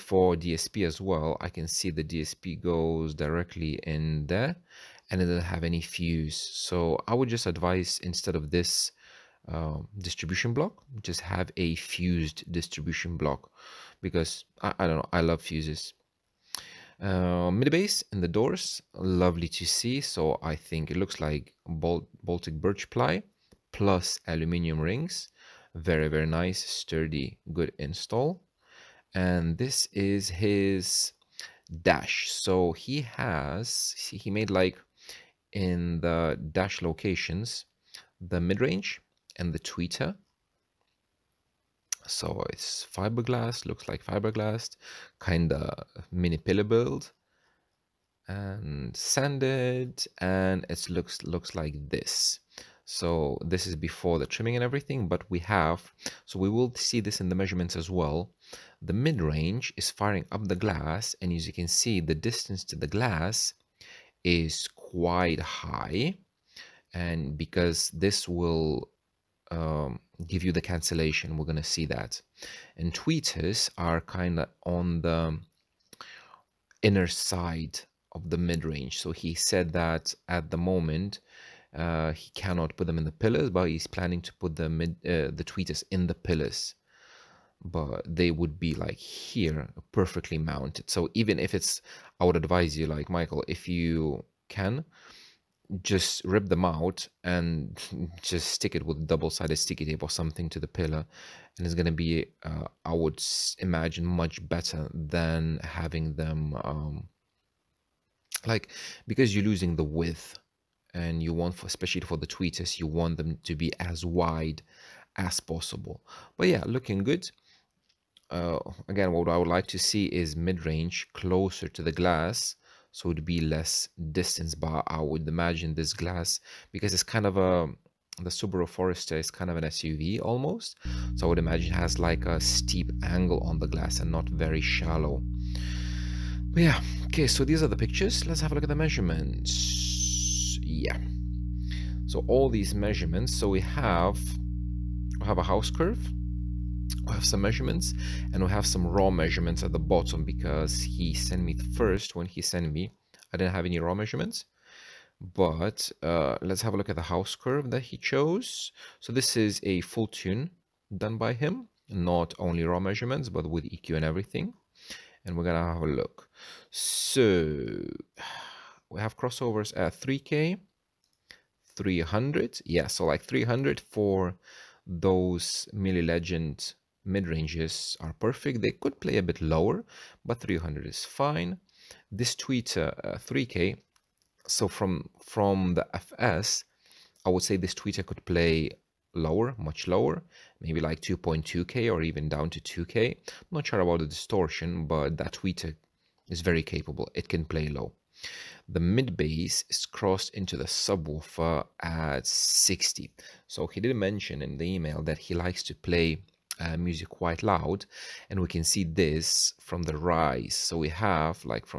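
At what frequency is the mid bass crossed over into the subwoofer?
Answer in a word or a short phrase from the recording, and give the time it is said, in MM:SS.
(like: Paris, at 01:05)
60, at 03:22.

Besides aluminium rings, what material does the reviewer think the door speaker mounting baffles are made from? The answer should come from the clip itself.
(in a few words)
Baltic birch ply.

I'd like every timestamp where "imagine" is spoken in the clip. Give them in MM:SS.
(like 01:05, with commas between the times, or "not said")
01:43, 02:05, 02:11.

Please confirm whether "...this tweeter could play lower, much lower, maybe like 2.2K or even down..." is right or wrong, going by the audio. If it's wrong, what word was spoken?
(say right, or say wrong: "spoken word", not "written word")
right.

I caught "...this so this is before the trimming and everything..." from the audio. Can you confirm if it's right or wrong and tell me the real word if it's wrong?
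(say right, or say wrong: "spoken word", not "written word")
right.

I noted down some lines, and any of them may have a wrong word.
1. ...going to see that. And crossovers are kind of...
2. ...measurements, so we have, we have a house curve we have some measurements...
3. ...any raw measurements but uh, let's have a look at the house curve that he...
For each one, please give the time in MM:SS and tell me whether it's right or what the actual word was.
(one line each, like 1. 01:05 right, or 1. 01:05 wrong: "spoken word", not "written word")
1. 01:11 wrong: "tweeters", not "crossovers"
2. 02:22 right
3. 02:33 right.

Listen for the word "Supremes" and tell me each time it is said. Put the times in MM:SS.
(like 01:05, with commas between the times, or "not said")
not said.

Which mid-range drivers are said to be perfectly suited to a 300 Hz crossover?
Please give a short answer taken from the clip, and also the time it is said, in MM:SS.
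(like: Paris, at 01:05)
Mille Legend, at 02:55.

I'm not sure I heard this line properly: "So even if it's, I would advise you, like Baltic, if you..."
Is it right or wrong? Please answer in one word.
wrong.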